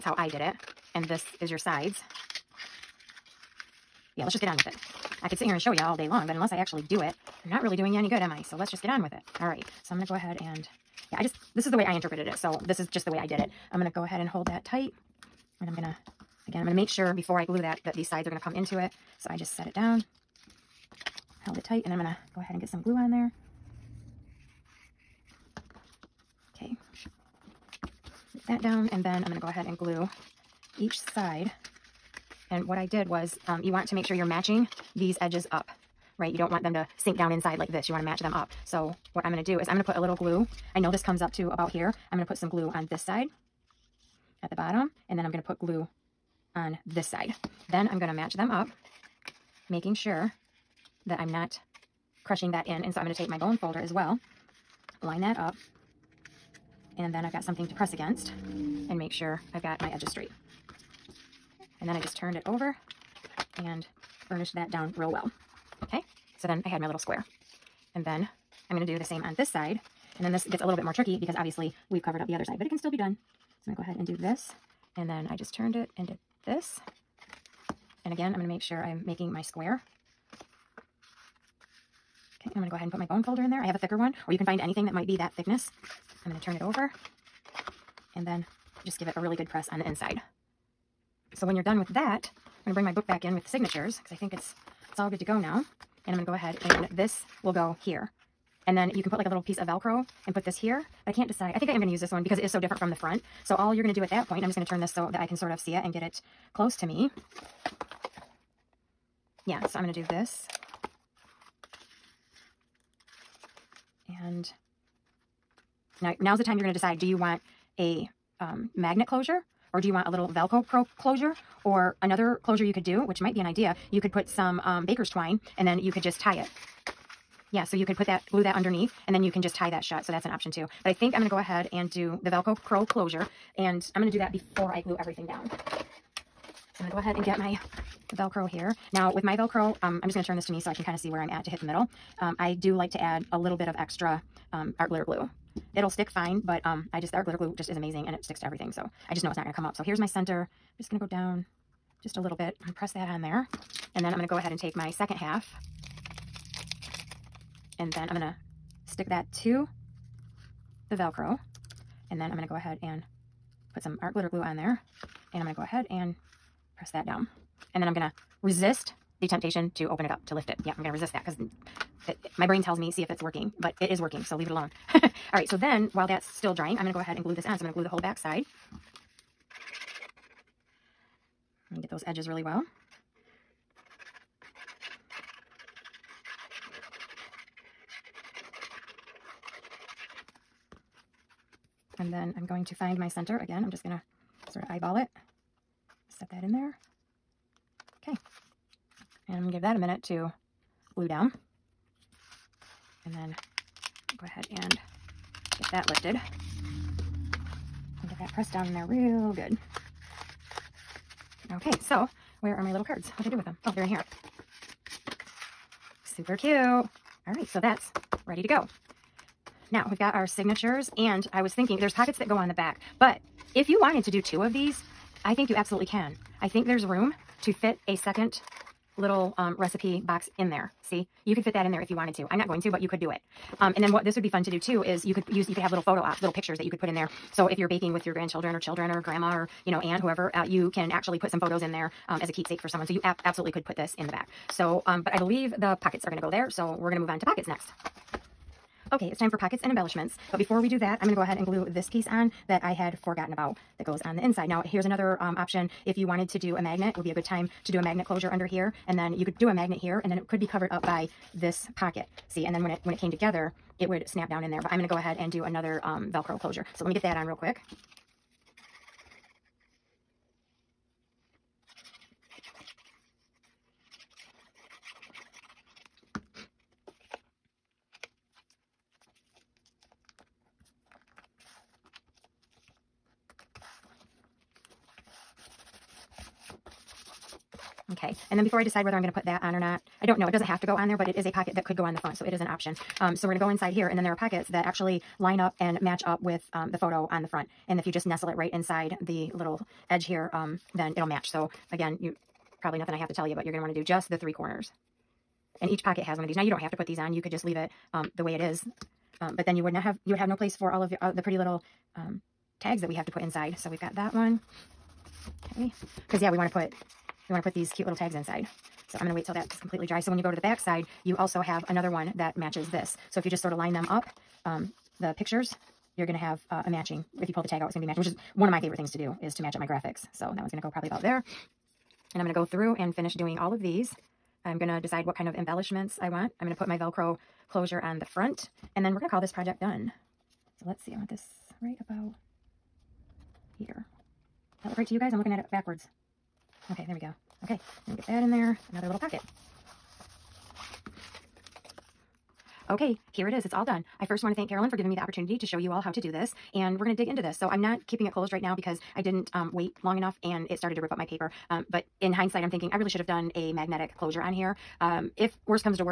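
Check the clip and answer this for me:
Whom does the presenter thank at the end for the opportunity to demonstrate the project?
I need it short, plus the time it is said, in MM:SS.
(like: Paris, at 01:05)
Carolyn, at 05:54.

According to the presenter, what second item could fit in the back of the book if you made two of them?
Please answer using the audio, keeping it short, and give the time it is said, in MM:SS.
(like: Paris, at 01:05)
Recipe box, at 03:49.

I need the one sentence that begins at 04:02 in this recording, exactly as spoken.
So you absolutely could put this in the back.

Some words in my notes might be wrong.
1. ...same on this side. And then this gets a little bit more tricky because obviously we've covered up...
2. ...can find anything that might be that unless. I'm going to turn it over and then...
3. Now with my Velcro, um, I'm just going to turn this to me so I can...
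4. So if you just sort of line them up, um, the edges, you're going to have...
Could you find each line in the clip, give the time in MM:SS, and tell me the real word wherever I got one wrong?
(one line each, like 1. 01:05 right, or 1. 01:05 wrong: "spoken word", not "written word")
1. 01:09 right
2. 01:24 wrong: "thickness", not "unless"
3. 02:18 right
4. 05:23 wrong: "pictures", not "edges".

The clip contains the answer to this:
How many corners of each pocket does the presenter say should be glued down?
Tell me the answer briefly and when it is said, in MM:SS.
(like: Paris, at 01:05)
3, at 05:04.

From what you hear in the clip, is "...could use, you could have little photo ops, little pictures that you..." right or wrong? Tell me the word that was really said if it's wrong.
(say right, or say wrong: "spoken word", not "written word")
right.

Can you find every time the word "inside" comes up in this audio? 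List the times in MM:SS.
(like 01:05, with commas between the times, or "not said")
00:37, 01:29, 04:14, 04:53, 04:58, 05:13, 05:18.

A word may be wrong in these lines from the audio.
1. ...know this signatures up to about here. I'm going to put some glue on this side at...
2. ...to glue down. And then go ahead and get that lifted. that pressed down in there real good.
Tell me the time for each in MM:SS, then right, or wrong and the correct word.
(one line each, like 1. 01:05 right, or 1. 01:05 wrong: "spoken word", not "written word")
1. 00:40 wrong: "comes", not "signatures"
2. 03:20 right.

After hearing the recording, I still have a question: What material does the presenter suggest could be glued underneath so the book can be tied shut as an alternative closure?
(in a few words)
Baker's twine.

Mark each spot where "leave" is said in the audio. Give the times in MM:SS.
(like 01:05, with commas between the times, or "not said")
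02:54, 05:07.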